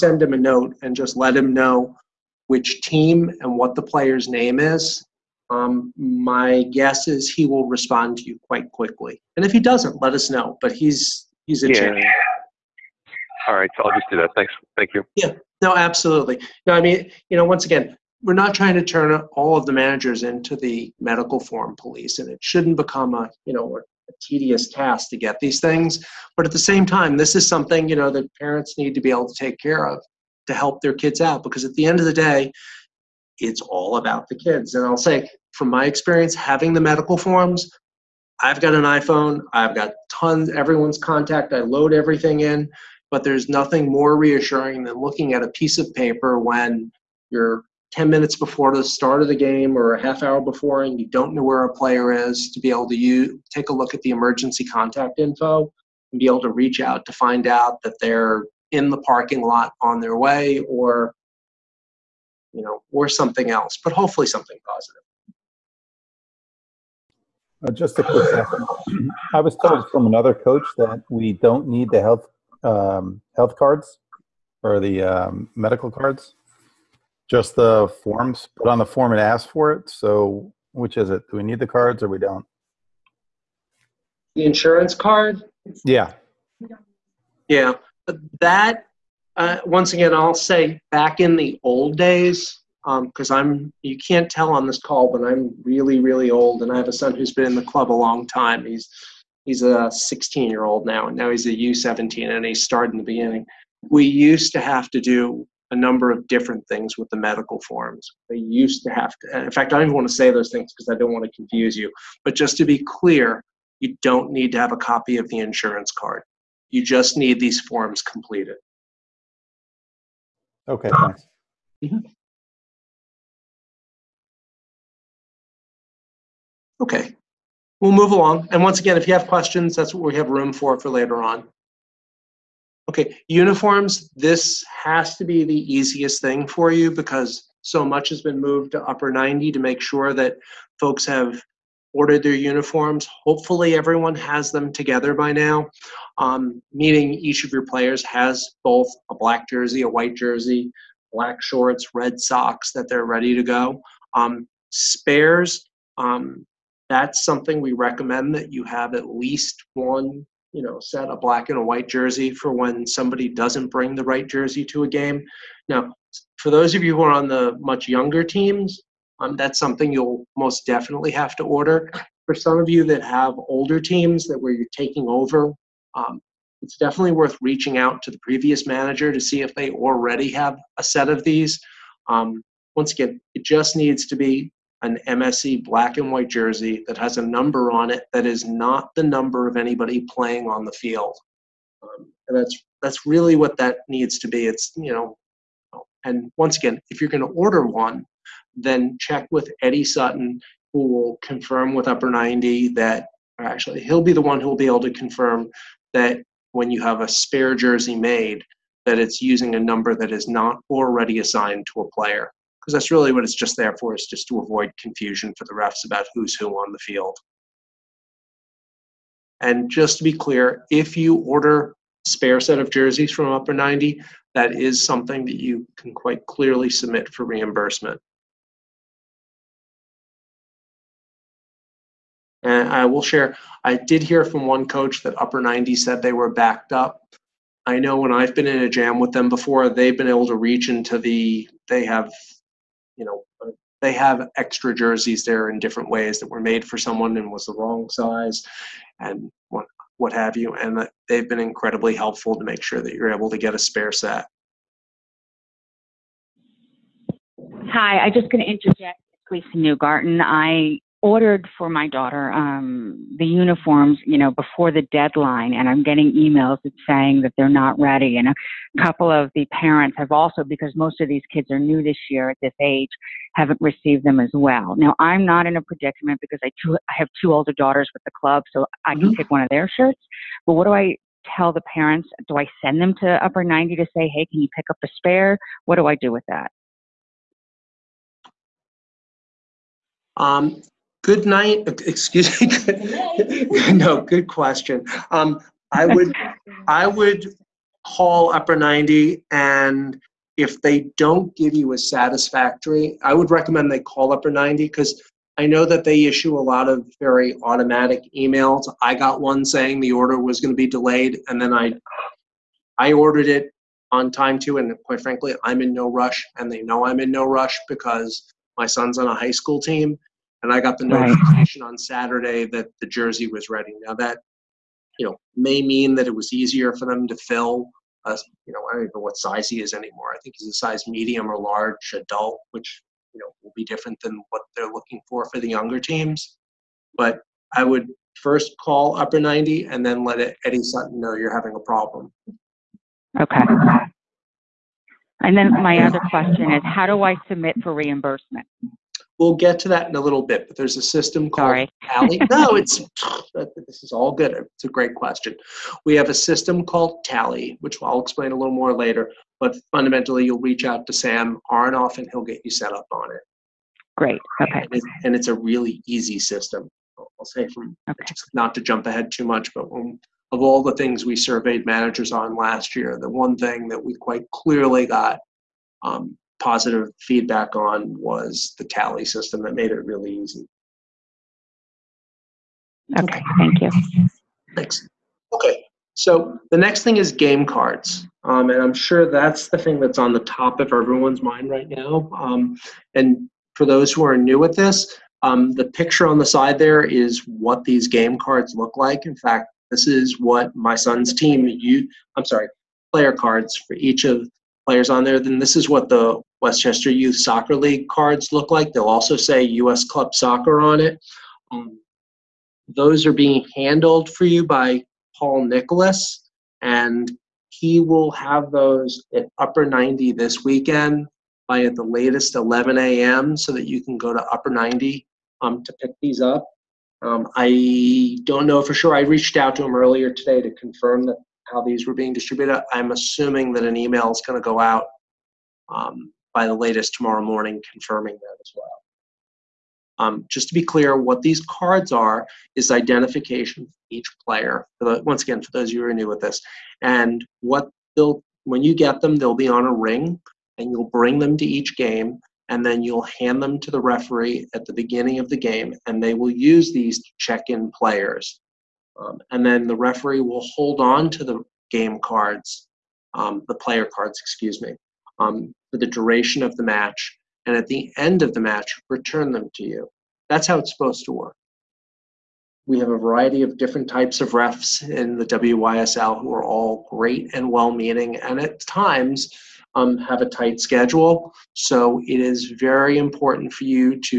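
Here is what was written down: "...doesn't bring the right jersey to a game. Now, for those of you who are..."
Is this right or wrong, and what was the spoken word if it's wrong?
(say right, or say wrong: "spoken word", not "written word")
right.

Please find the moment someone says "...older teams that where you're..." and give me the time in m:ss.
2:53.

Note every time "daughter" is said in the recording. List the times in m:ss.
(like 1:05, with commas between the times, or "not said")
4:21, 4:37.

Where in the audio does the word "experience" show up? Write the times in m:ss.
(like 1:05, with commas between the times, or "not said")
0:35.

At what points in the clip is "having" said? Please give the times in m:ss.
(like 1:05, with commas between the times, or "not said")
0:36, 5:41.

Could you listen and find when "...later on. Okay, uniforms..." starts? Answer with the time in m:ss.
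2:10.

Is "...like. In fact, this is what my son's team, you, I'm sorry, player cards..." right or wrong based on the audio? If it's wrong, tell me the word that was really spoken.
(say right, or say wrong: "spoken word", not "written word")
right.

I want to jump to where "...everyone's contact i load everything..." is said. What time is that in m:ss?
0:40.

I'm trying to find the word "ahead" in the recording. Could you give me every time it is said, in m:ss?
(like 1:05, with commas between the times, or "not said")
6:08.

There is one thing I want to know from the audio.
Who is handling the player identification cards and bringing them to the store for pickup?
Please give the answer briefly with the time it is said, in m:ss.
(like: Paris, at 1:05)
Paul Nicholas, at 6:55.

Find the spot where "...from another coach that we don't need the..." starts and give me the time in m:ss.
1:09.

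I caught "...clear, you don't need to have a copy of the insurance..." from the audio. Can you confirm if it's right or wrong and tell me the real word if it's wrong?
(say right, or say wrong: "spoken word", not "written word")
right.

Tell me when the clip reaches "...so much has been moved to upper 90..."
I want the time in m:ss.
2:17.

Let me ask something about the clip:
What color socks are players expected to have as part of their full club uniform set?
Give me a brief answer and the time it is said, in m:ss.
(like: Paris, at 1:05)
red, at 2:31.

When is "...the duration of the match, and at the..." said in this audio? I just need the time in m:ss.
7:45.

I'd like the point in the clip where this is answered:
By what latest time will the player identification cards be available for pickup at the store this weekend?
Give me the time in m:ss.
7:02.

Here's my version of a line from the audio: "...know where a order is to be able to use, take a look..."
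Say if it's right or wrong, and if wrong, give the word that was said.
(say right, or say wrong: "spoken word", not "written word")
wrong: "player", not "order".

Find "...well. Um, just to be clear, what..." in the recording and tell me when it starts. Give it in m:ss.
7:18.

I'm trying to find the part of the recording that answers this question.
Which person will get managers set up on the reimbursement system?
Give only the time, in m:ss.
6:00.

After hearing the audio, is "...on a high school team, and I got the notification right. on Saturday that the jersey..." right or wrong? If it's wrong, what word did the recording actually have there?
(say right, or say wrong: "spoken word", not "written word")
right.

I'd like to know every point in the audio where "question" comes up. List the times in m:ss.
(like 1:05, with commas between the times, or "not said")
2:09, 4:54, 5:46, 5:54.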